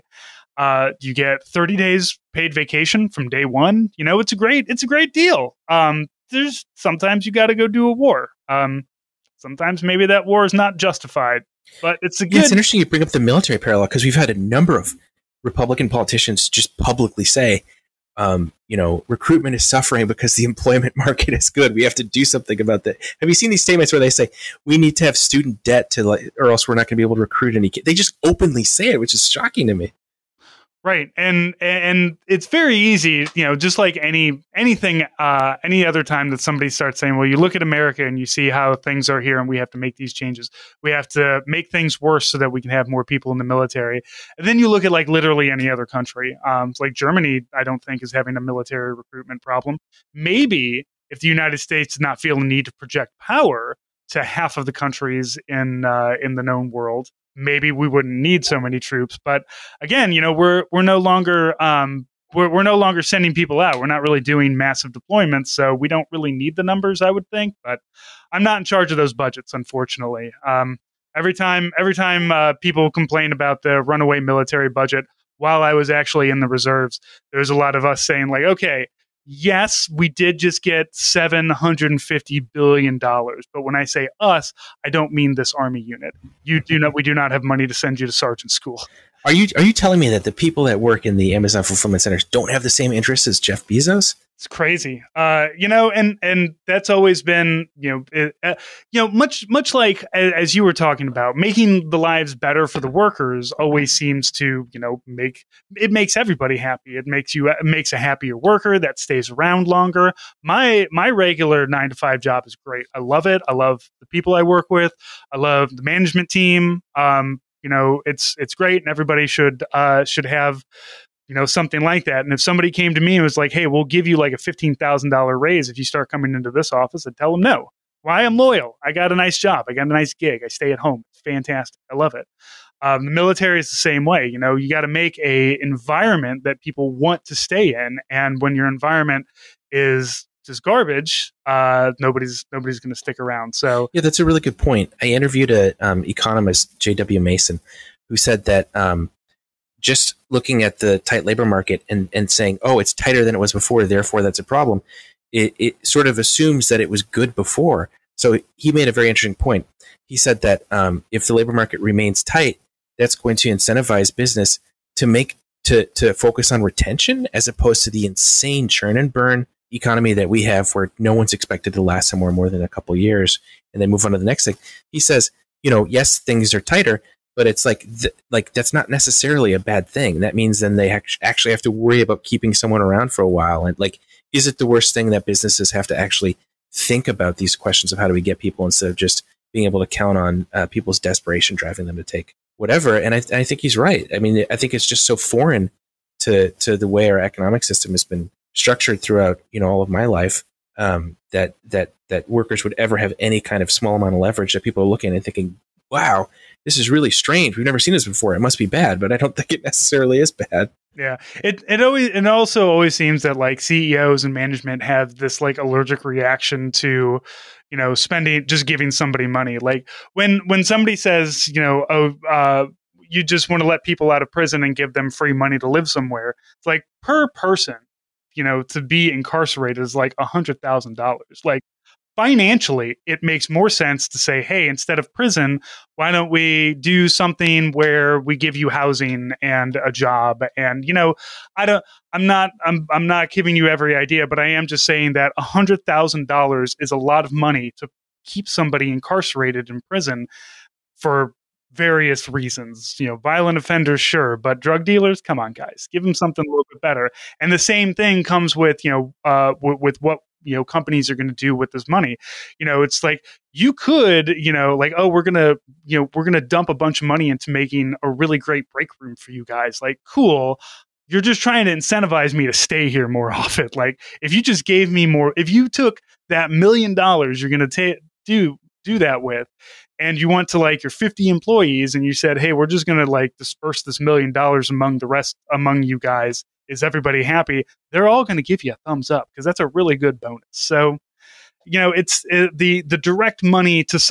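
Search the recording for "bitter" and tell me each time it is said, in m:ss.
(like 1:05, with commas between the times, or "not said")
not said.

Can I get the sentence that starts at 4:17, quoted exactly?
And the same thing comes with you know uh, w- with what you know companies are going to do with this money.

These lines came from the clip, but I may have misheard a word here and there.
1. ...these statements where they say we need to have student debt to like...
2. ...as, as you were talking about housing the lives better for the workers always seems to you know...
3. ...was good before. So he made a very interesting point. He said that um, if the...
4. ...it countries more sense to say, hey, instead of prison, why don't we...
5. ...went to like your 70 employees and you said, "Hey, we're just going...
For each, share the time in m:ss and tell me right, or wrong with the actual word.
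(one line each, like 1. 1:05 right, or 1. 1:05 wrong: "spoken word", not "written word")
1. 0:23 right
2. 1:40 wrong: "making", not "housing"
3. 2:36 right
4. 3:53 wrong: "makes", not "countries"
5. 4:40 wrong: "50", not "70".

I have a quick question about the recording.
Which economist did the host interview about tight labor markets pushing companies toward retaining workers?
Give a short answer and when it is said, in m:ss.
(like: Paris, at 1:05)
J.W. Mason, at 2:26.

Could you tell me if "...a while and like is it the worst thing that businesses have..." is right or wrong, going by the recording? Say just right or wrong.
right.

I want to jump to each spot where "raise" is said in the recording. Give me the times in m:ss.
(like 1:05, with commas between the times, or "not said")
2:05.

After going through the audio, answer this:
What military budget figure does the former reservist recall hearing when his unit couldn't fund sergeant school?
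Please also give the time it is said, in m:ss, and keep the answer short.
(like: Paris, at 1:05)
$750 billion, at 1:20.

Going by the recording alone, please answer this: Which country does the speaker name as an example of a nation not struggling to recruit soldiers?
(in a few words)
Germany.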